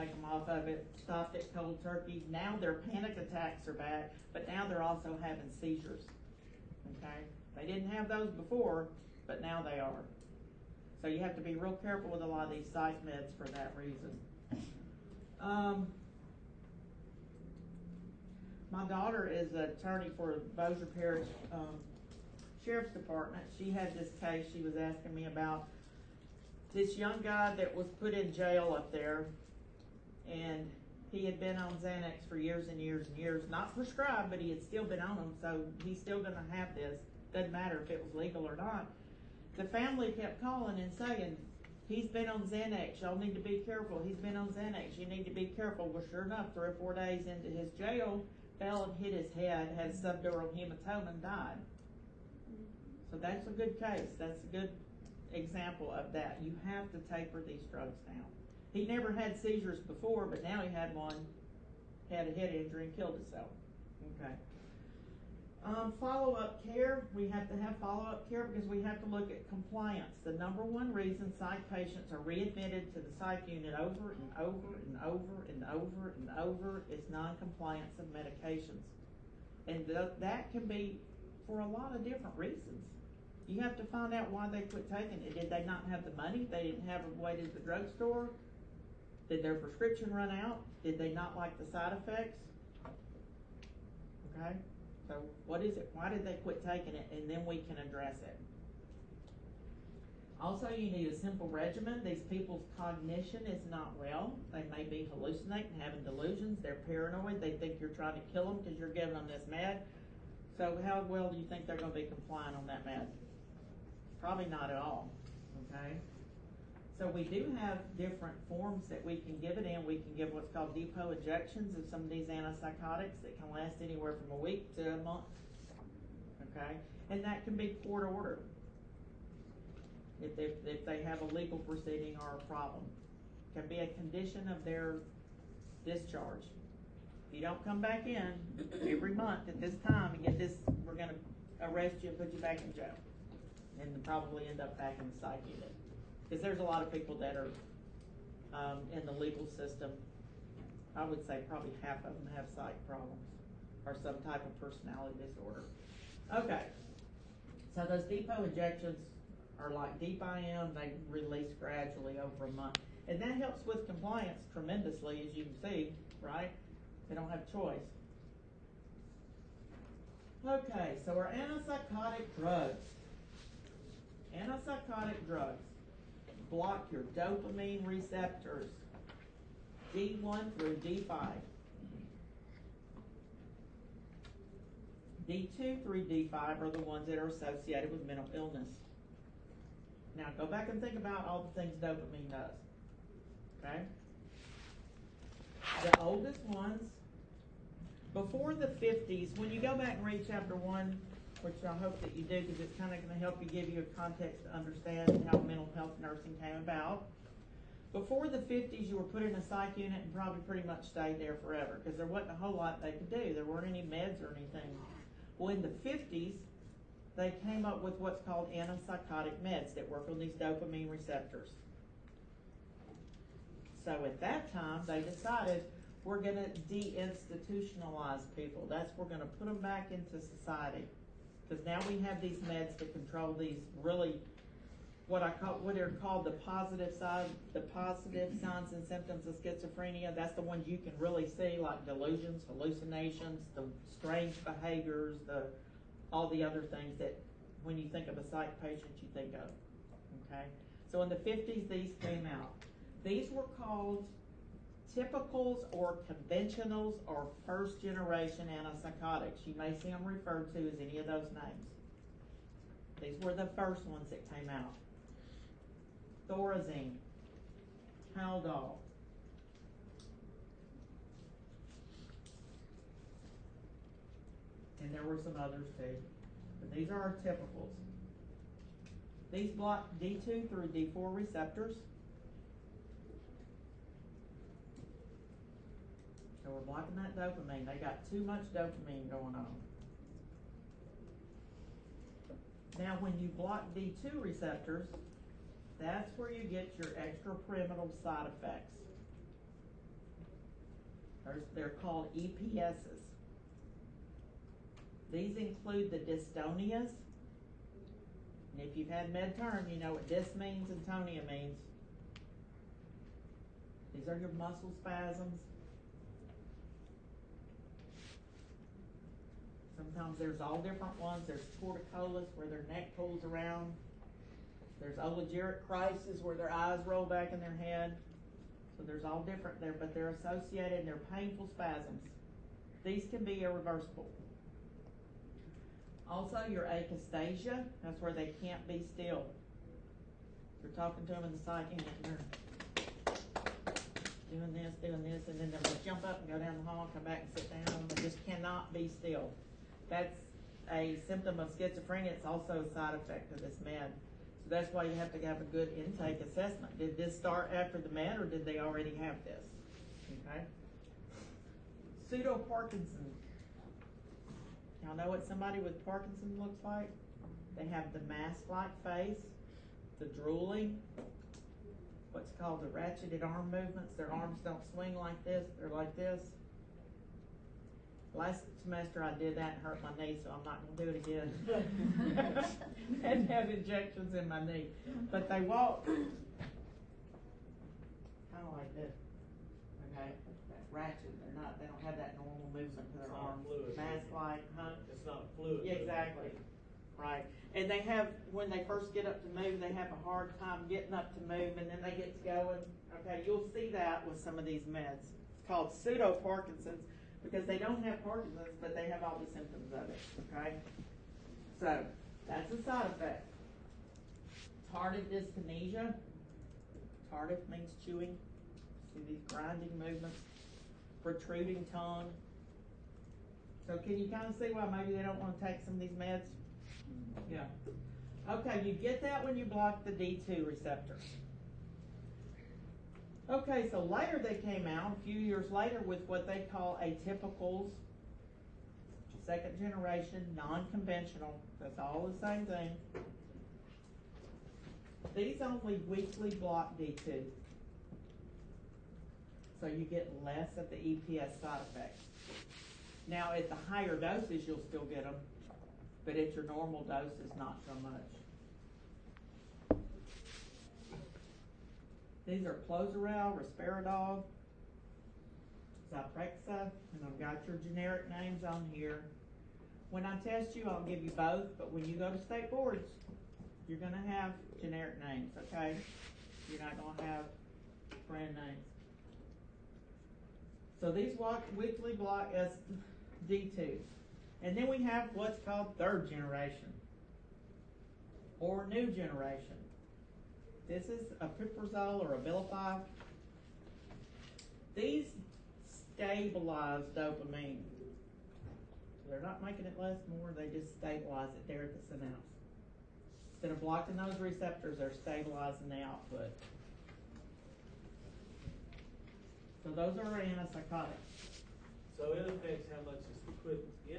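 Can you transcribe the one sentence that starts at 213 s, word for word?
There weren't any meds or anything.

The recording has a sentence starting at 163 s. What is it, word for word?
And that helps with compliance tremendously, as you can see, right?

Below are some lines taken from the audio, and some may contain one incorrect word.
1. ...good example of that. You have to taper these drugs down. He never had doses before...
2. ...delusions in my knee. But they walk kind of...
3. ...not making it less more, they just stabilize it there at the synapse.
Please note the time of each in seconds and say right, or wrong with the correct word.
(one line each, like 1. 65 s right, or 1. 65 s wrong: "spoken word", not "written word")
1. 54 s wrong: "seizures", not "doses"
2. 383 s wrong: "injections", not "delusions"
3. 499 s right.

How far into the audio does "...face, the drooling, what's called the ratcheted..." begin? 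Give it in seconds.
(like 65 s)
368 s.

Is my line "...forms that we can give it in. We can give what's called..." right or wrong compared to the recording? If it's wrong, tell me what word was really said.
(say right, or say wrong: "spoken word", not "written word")
right.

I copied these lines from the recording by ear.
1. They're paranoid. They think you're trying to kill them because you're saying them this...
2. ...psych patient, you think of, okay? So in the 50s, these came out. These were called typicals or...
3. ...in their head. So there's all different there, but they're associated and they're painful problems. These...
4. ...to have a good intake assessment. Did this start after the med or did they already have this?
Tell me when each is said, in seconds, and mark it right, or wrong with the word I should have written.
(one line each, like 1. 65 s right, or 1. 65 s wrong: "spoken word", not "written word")
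1. 106 s wrong: "giving", not "saying"
2. 248 s right
3. 327 s wrong: "spasms", not "problems"
4. 355 s right.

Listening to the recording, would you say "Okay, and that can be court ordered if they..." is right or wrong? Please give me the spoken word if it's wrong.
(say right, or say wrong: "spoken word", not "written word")
right.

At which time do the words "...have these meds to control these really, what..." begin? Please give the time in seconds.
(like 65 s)
232 s.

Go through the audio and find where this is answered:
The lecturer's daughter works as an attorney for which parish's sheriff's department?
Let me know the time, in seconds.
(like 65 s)
20 s.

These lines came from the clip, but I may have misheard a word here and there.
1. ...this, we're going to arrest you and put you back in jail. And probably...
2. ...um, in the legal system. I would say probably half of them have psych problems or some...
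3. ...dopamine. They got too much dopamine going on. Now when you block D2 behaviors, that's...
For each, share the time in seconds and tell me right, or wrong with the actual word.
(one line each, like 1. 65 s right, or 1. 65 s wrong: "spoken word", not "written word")
1. 140 s right
2. 148 s right
3. 287 s wrong: "receptors", not "behaviors".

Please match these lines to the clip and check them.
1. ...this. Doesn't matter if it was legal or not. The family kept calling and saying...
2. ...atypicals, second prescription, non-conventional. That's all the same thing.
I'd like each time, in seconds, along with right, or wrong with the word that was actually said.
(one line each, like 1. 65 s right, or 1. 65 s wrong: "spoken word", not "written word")
1. 36 s right
2. 436 s wrong: "generation", not "prescription".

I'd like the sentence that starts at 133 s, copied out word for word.
It can be a condition of their discharge.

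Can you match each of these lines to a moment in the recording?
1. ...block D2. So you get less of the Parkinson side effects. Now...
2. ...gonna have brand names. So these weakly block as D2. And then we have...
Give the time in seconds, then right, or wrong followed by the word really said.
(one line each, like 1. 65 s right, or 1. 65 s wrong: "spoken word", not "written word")
1. 446 s wrong: "EPS", not "Parkinson"
2. 476 s right.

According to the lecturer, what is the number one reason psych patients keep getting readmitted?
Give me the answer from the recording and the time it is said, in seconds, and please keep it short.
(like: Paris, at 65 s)
Non-compliance of medications, at 77 s.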